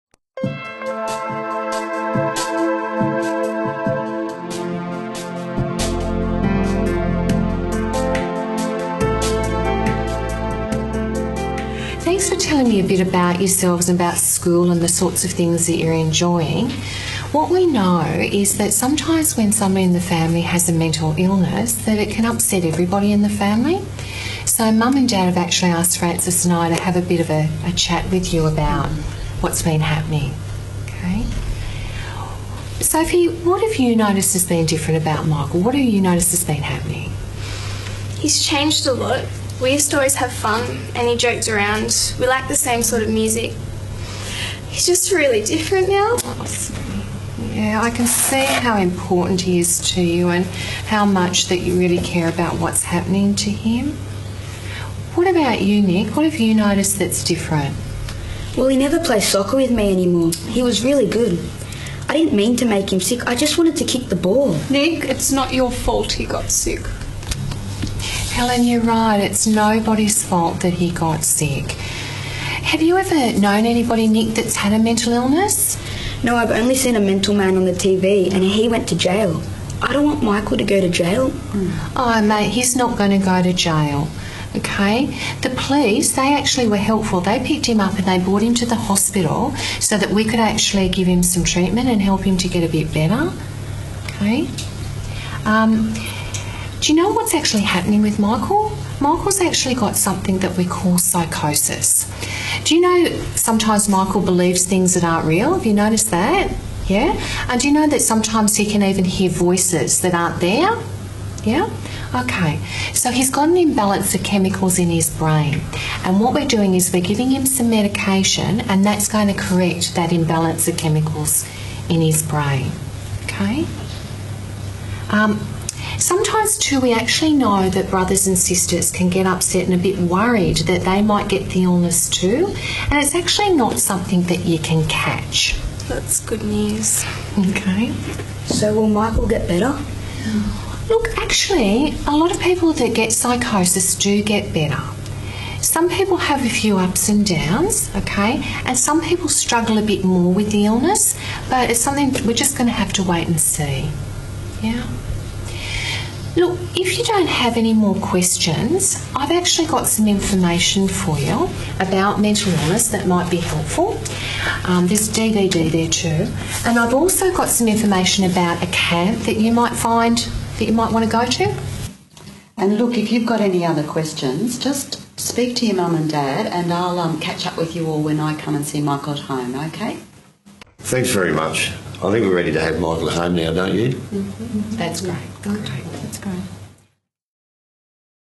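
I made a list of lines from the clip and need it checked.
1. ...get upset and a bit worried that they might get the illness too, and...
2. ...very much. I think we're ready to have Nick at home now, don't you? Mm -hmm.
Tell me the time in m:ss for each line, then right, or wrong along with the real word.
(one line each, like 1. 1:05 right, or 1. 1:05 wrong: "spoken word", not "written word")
1. 2:09 right
2. 3:01 wrong: "Michael", not "Nick".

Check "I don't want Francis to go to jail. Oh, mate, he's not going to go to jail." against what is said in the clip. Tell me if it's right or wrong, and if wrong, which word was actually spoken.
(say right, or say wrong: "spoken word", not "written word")
wrong: "Michael", not "Francis".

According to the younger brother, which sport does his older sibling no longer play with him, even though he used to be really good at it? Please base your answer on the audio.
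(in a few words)
soccer.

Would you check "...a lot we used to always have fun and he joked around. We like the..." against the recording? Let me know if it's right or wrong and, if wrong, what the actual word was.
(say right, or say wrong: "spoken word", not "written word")
right.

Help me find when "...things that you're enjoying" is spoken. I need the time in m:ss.
0:15.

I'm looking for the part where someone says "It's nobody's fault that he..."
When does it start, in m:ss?
1:09.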